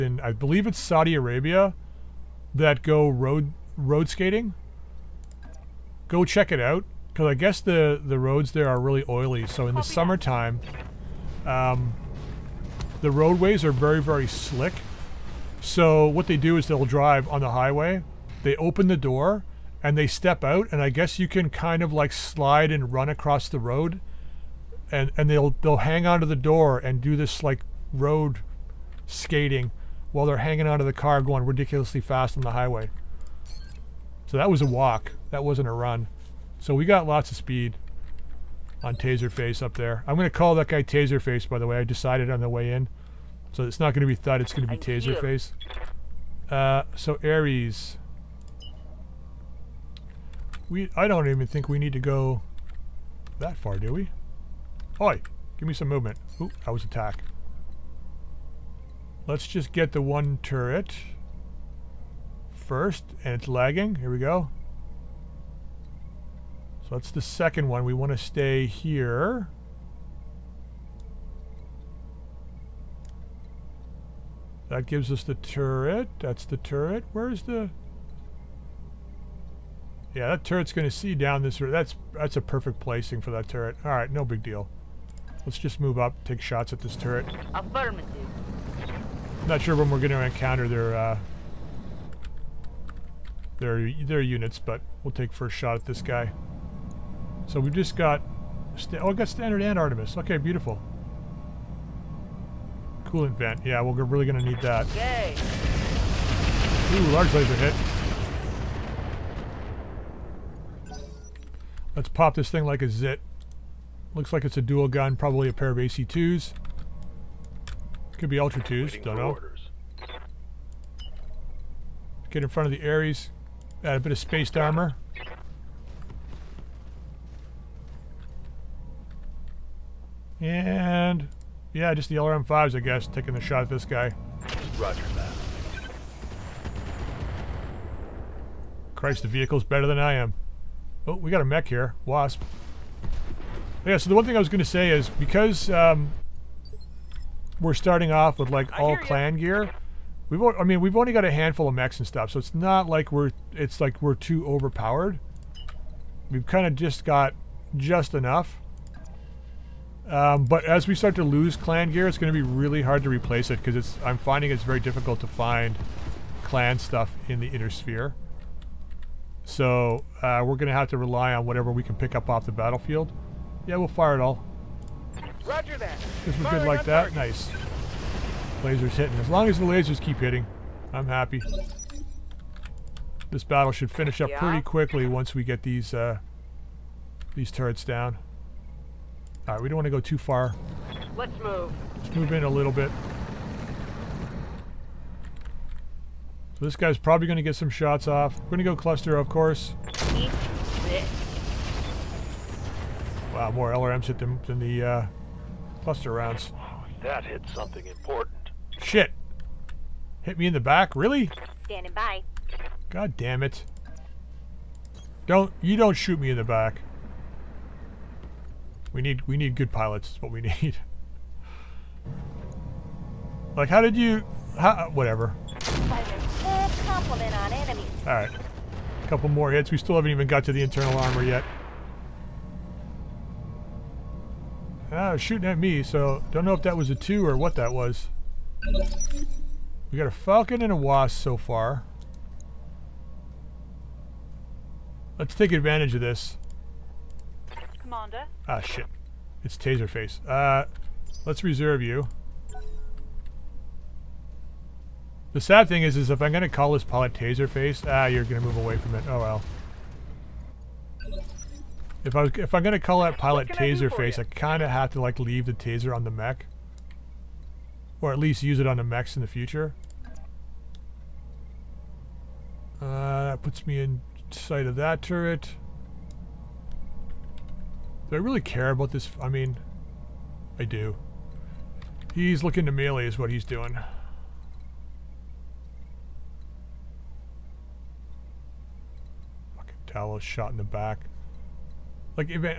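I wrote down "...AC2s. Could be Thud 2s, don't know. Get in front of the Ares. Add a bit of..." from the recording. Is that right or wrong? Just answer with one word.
wrong.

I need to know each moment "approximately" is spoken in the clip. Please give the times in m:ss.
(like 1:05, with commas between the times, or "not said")
not said.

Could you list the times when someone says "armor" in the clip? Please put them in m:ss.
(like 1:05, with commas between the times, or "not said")
2:04, 3:50.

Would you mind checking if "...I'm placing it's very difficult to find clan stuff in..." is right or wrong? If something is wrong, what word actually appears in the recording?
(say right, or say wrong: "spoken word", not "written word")
wrong: "finding", not "placing".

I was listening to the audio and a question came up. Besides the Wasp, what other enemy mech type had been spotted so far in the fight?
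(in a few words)
Falcon.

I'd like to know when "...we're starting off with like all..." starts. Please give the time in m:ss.
2:27.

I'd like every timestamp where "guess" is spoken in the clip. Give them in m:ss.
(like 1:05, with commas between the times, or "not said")
0:07, 0:20, 2:12.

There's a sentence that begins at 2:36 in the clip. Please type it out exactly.
We've kind of just got just enough.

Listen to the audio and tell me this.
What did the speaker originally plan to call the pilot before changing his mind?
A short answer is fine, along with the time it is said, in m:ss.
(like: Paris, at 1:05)
Thud, at 0:44.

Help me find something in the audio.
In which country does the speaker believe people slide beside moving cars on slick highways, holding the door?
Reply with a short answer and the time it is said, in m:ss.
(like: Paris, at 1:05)
Saudi Arabia, at 0:00.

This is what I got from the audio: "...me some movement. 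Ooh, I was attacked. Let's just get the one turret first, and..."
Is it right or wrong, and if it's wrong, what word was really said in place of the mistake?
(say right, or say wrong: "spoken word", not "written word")
right.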